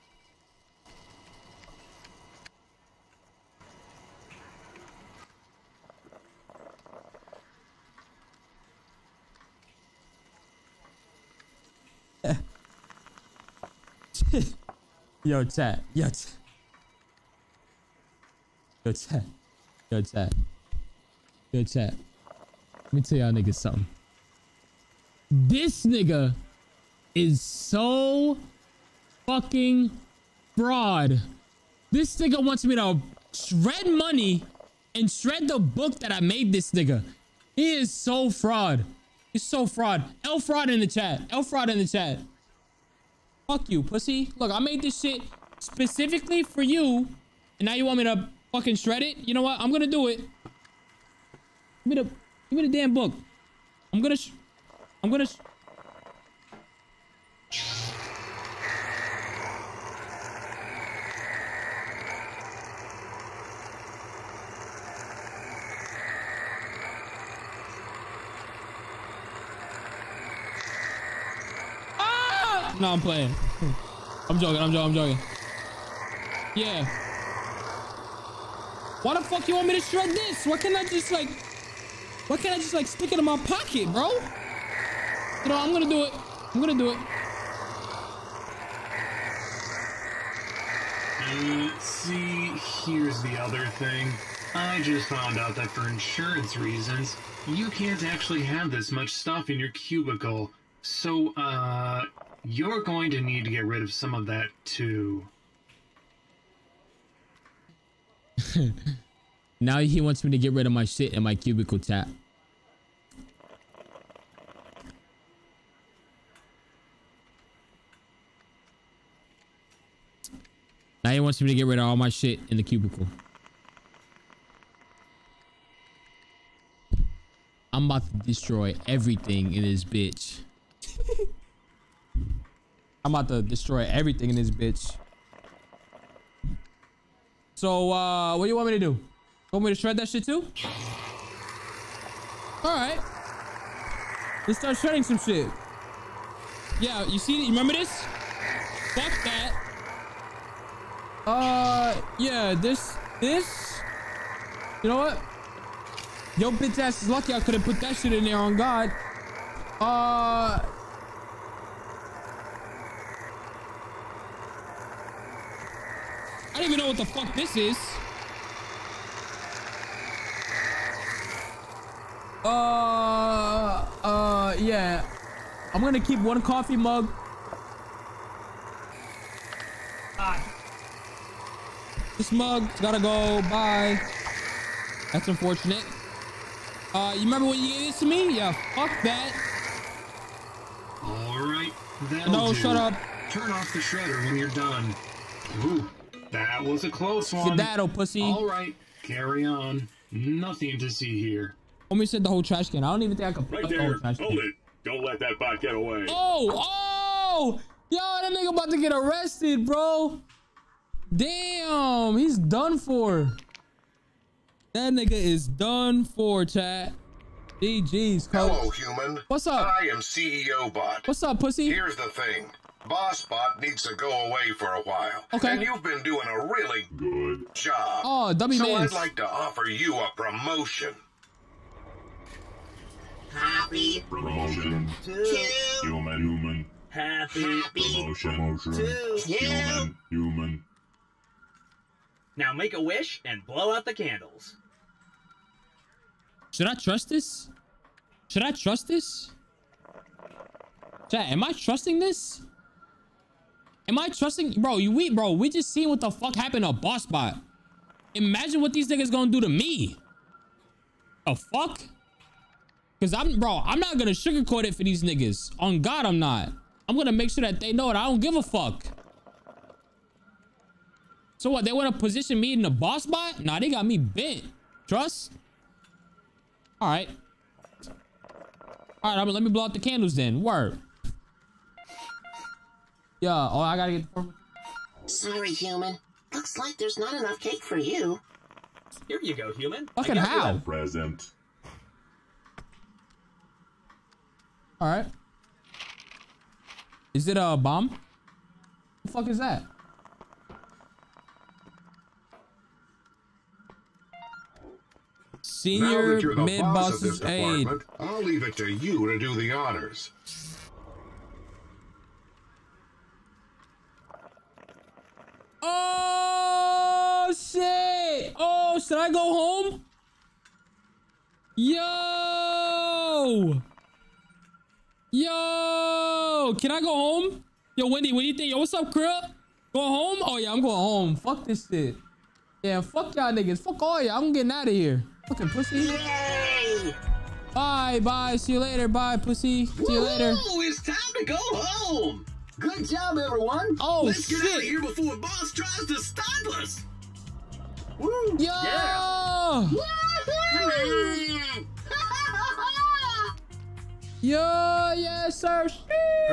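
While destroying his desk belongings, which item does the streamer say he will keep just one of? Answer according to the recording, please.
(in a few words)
Coffee mug.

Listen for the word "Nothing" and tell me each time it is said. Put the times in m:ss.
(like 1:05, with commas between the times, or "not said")
3:20.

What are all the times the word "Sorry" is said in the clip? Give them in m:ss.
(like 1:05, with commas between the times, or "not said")
4:45.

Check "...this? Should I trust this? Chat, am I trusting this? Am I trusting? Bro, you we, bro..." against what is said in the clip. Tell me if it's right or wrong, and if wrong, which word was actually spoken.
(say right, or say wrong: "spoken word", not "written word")
right.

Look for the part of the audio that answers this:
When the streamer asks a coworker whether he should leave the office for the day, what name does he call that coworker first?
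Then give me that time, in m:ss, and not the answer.
5:27.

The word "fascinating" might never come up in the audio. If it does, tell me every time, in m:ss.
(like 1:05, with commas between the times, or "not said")
not said.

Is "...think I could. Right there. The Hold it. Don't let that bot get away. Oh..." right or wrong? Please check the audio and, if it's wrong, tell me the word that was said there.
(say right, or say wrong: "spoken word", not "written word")
right.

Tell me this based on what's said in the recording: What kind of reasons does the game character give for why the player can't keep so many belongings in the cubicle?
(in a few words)
Insurance.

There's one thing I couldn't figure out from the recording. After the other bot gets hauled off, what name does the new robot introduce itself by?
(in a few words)
CEO Bot.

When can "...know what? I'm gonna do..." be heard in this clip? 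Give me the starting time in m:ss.
0:49.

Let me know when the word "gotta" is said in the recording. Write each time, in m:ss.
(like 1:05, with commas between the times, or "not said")
3:02, 4:43.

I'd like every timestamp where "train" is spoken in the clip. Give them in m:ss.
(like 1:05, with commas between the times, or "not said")
not said.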